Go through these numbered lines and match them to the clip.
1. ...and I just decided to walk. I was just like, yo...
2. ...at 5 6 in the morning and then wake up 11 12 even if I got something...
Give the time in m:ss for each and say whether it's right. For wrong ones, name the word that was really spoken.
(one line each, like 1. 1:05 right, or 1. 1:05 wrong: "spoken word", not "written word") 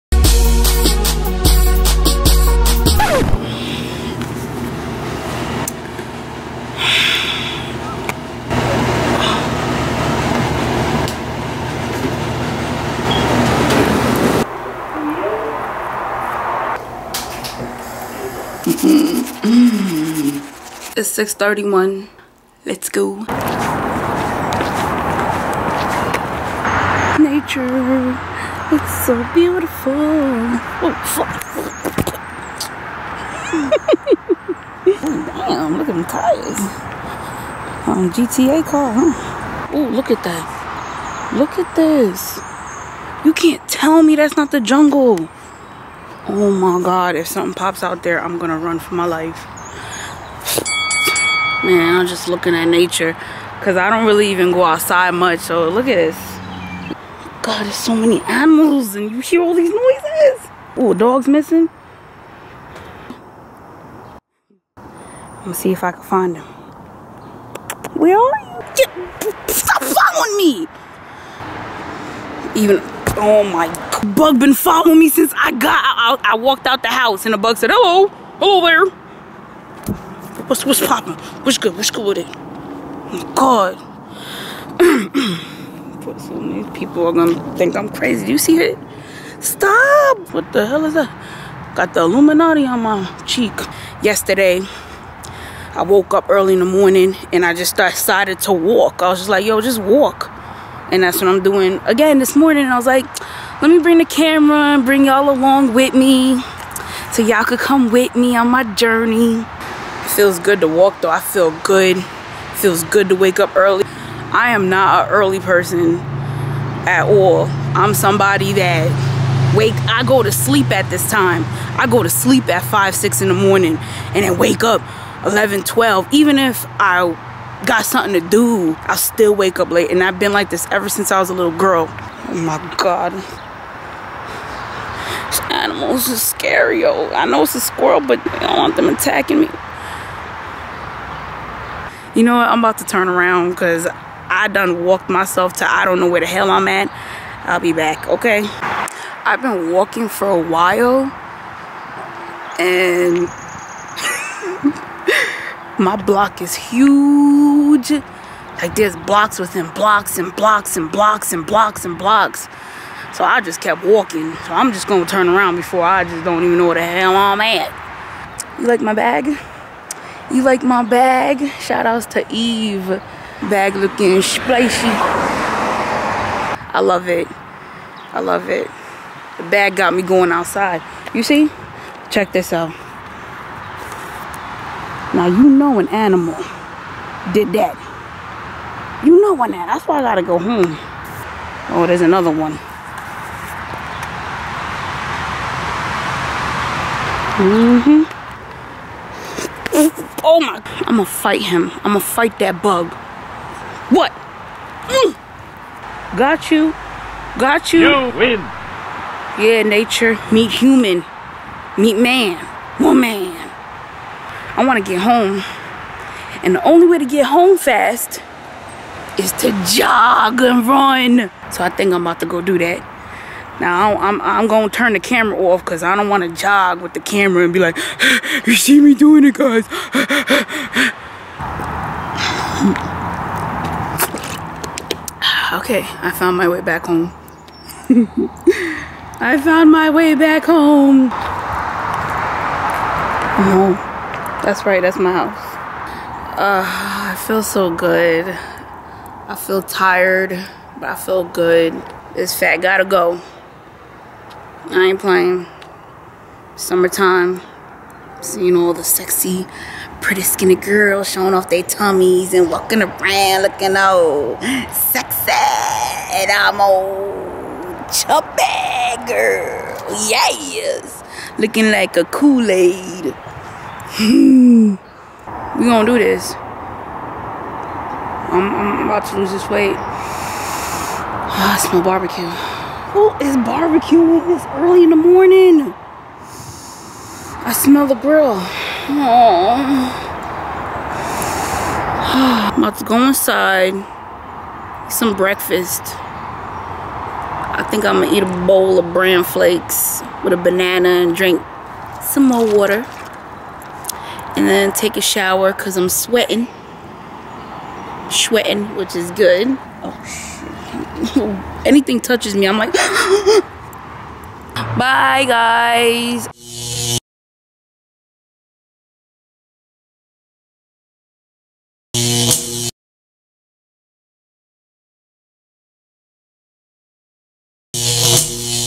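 1. 1:37 right
2. 2:02 right.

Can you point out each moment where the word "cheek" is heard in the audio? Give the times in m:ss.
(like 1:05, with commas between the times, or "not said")
1:33.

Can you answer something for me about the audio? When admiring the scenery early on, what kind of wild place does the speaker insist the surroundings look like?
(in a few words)
the jungle.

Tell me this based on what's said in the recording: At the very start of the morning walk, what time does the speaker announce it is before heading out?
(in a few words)
6:31.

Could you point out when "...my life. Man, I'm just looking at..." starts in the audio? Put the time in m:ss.
0:48.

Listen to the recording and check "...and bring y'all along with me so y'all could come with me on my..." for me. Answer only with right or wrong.
right.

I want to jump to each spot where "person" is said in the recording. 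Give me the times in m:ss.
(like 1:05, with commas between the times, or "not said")
1:55.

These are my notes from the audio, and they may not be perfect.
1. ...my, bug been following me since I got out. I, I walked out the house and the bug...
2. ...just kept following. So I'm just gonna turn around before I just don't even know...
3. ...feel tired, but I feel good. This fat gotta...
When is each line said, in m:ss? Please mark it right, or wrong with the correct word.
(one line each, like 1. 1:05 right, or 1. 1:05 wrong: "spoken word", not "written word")
1. 1:13 right
2. 2:43 wrong: "walking", not "following"
3. 4:09 right.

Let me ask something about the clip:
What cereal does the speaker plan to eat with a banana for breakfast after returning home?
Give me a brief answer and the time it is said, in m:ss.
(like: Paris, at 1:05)
bran flakes, at 4:58.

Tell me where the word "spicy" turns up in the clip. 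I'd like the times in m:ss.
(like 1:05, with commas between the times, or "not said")
2:54.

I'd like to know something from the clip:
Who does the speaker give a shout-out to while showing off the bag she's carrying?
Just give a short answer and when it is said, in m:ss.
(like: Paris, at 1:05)
Eve, at 2:52.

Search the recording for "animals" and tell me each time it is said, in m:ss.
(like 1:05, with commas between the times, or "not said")
0:58, 2:15, 3:05.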